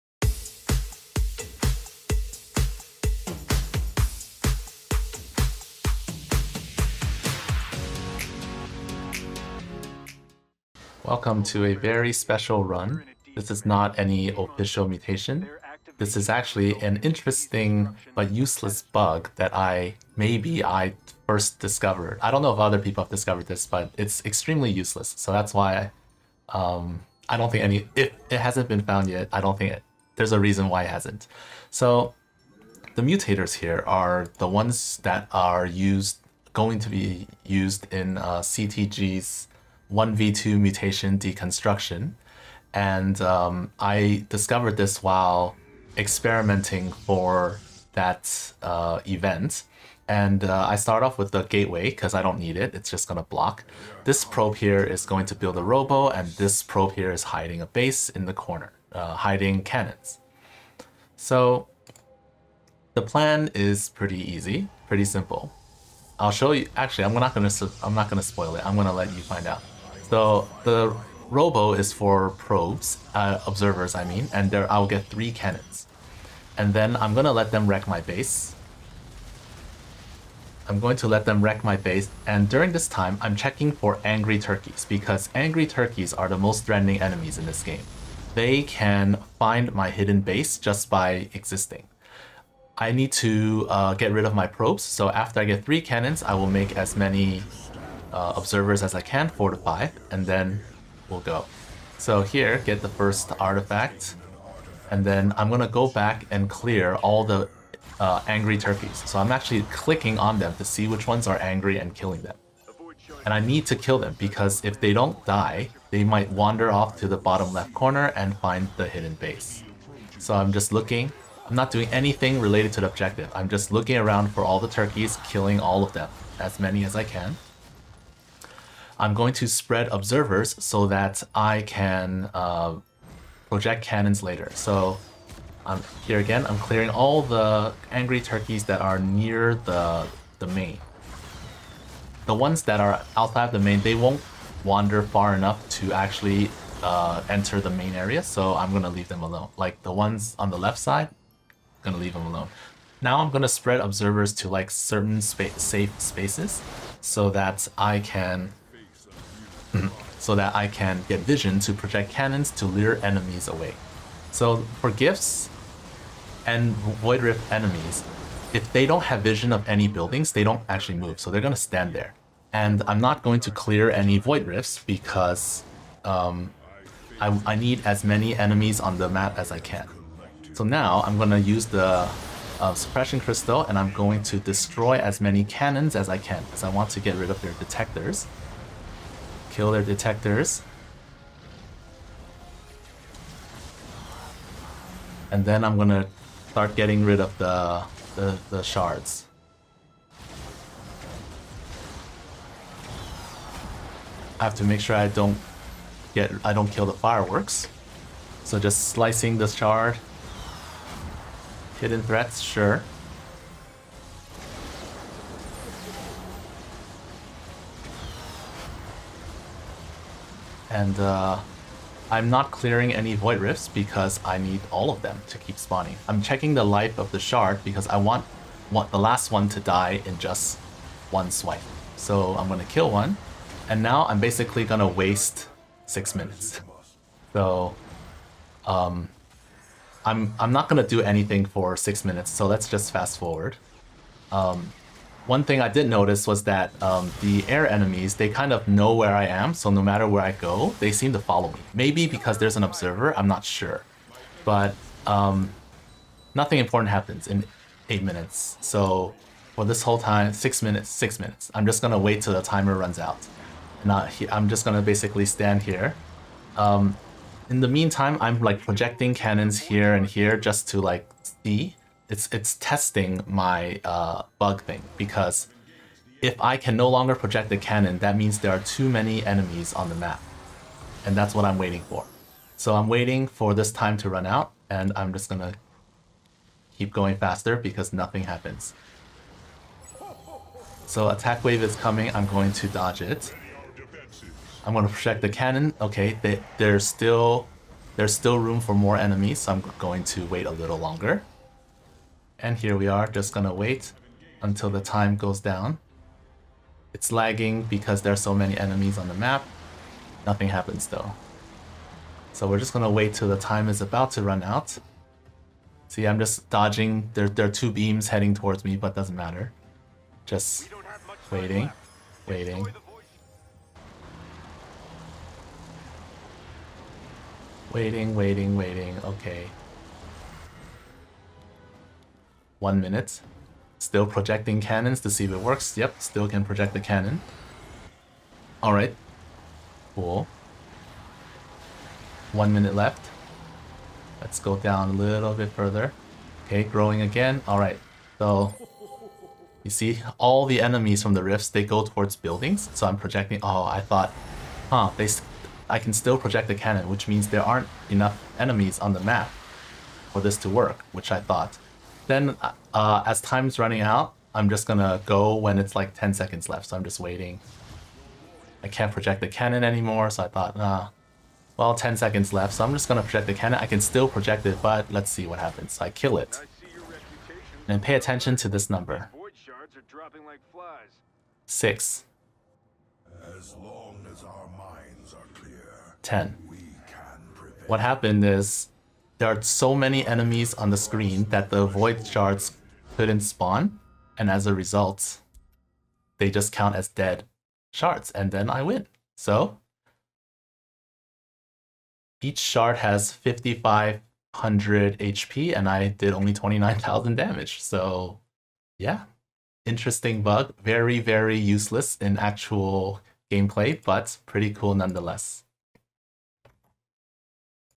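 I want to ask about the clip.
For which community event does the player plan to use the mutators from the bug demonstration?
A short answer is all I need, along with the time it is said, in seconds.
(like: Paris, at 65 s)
CTG's 1v2 mutation, at 38 s.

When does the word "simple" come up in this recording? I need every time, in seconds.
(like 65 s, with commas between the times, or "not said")
65 s.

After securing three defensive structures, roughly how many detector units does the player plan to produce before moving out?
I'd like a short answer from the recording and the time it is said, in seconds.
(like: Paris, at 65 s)
4 to 5, at 99 s.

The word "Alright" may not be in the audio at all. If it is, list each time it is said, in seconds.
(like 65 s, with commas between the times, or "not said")
338 s, 347 s.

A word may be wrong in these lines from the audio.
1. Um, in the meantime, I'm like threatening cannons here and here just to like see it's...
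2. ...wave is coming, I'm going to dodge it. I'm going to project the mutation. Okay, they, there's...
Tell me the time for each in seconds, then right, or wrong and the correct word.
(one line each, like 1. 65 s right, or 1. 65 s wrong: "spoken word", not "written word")
1. 266 s wrong: "projecting", not "threatening"
2. 291 s wrong: "cannon", not "mutation".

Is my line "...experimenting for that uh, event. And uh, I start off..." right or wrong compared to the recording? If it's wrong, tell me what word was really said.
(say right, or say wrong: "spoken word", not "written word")
right.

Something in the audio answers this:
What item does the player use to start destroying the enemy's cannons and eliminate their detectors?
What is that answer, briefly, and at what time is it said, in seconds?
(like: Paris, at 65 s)
Suppression crystal, at 182 s.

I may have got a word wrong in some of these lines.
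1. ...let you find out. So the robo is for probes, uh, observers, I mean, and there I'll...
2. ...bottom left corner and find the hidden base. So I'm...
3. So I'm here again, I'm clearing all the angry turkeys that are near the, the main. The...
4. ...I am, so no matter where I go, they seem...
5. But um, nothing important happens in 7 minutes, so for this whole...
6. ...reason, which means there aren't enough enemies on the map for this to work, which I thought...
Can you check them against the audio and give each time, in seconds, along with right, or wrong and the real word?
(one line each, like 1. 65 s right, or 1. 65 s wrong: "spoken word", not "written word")
1. 68 s right
2. 117 s right
3. 134 s right
4. 249 s right
5. 254 s wrong: "8", not "7"
6. 356 s wrong: "cannon", not "reason".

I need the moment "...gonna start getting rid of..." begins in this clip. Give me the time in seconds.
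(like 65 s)
195 s.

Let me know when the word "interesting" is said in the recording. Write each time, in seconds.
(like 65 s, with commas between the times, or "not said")
17 s, 409 s.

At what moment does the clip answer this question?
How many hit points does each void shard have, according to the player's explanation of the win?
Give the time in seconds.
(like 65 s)
403 s.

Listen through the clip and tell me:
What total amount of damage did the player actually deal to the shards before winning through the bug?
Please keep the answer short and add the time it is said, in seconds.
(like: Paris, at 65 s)
29,000, at 406 s.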